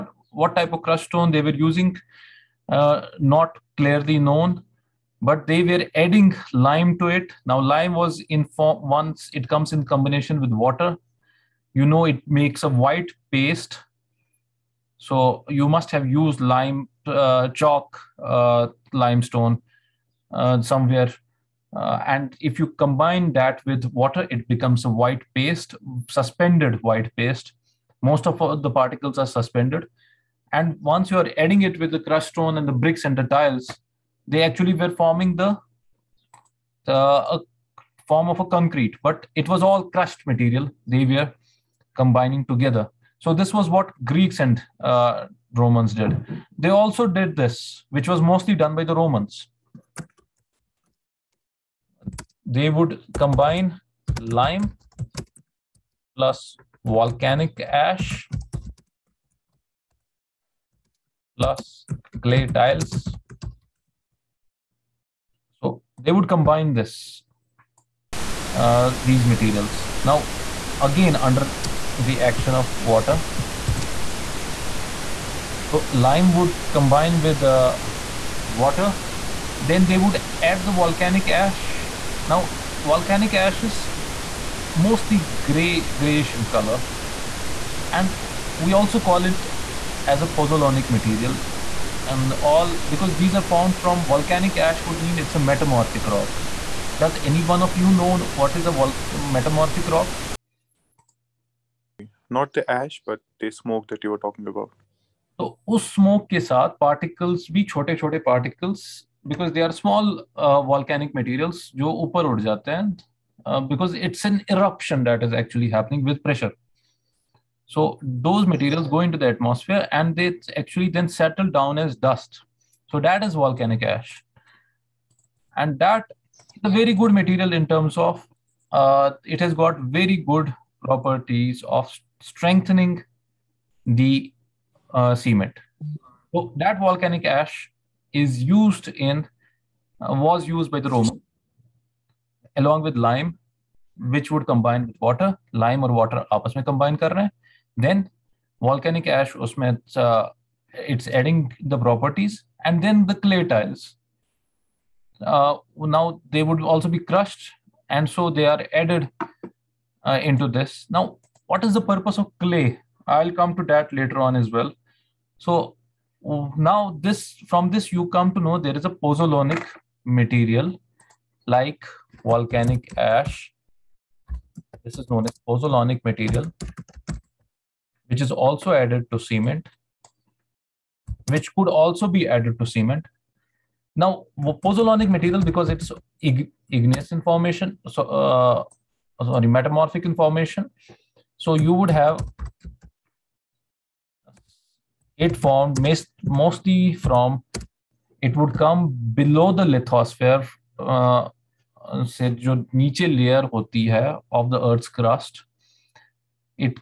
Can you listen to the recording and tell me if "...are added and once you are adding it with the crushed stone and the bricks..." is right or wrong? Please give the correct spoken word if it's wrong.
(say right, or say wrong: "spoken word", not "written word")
wrong: "suspended", not "added".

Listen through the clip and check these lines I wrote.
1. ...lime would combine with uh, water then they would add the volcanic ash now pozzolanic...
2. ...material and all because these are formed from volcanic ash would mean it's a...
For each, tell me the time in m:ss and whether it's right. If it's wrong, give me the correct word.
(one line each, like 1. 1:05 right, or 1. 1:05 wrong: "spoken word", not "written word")
1. 1:15 wrong: "volcanic", not "pozzolanic"
2. 1:30 right.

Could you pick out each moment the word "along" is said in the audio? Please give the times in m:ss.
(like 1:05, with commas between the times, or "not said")
2:22.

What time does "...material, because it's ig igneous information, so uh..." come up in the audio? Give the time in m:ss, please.
3:05.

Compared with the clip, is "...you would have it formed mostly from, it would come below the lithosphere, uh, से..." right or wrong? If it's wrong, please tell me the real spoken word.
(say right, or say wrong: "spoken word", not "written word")
right.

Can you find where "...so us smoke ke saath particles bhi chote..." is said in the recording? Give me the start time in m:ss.
1:45.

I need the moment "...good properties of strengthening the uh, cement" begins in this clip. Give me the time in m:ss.
2:10.